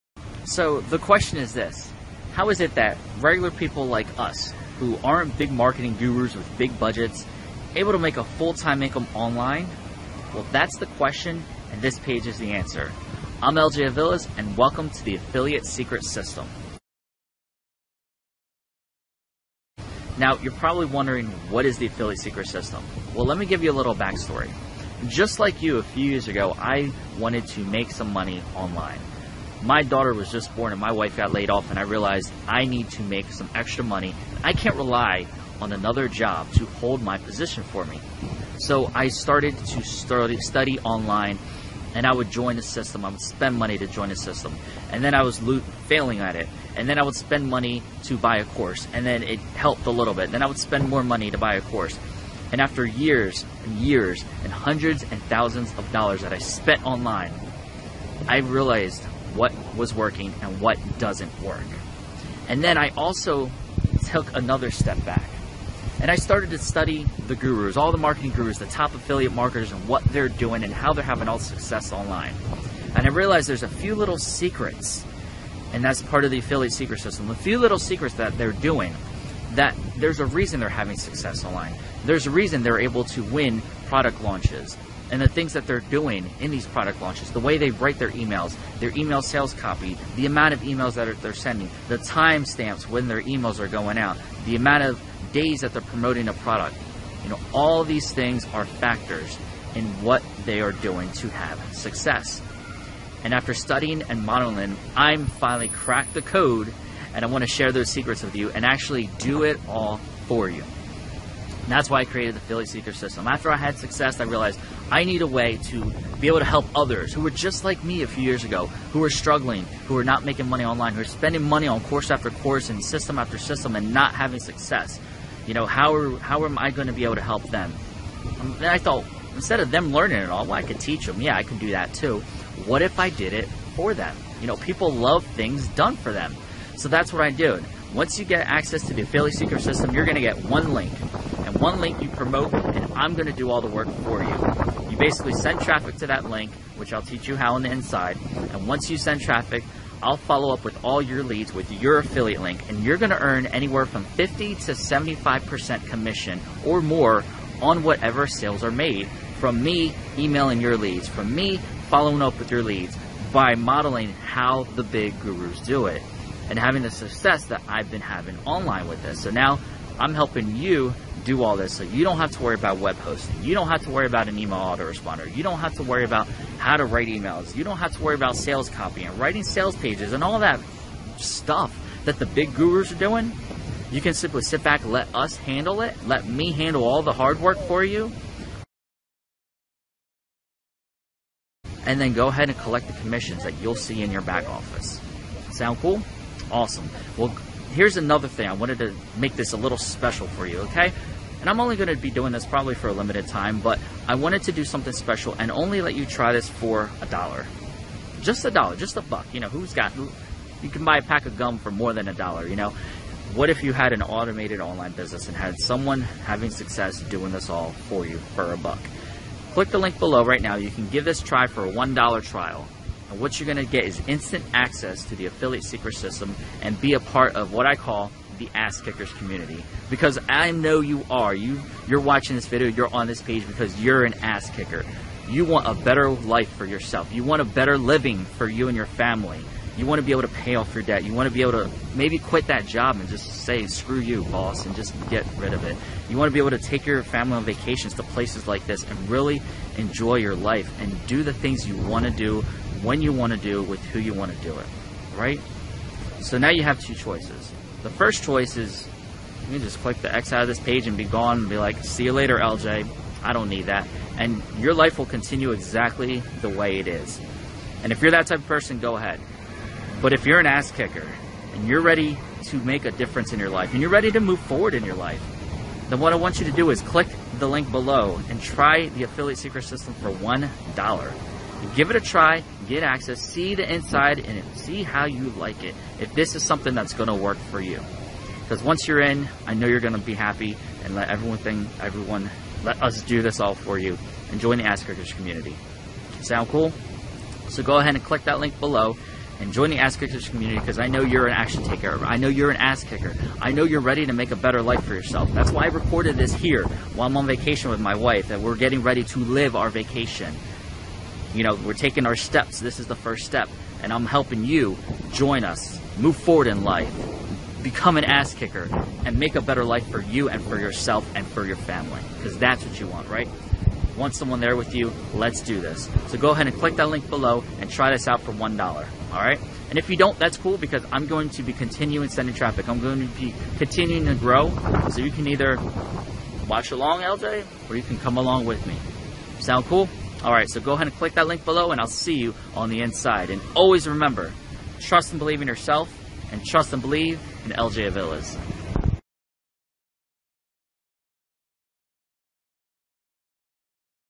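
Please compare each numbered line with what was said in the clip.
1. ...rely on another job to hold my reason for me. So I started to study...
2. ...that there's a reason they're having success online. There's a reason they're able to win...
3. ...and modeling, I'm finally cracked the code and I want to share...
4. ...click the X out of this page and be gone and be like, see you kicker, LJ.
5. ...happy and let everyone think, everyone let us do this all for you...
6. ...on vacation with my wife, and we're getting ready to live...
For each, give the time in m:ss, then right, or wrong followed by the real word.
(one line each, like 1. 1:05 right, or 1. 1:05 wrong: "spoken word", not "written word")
1. 0:34 wrong: "position", not "reason"
2. 1:19 right
3. 1:44 right
4. 4:19 wrong: "later", not "kicker"
5. 4:50 right
6. 5:07 right.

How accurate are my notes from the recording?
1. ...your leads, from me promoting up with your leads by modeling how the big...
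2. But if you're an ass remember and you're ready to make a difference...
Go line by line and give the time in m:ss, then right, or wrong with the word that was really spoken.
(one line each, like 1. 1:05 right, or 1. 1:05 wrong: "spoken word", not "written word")
1. 2:40 wrong: "following", not "promoting"
2. 4:30 wrong: "kicker", not "remember".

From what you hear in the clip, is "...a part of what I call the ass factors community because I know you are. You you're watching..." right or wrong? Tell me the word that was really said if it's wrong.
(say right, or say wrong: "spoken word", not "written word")
wrong: "kickers", not "factors".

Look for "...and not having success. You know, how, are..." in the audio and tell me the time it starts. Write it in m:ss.
2:03.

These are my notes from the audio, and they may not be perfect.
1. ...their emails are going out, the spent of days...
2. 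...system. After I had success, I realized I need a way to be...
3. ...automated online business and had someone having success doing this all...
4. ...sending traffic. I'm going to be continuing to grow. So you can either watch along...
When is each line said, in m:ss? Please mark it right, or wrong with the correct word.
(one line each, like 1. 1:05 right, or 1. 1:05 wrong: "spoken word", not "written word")
1. 1:33 wrong: "amount", not "spent"
2. 1:52 right
3. 3:34 right
4. 5:32 right.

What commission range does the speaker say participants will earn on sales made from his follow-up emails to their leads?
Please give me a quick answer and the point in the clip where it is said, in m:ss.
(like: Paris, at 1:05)
50 to 75%, at 2:34.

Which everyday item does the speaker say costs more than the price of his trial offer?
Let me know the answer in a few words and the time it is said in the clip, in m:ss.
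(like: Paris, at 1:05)
pack of gum, at 3:31.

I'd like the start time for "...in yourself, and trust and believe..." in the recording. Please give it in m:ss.
5:45.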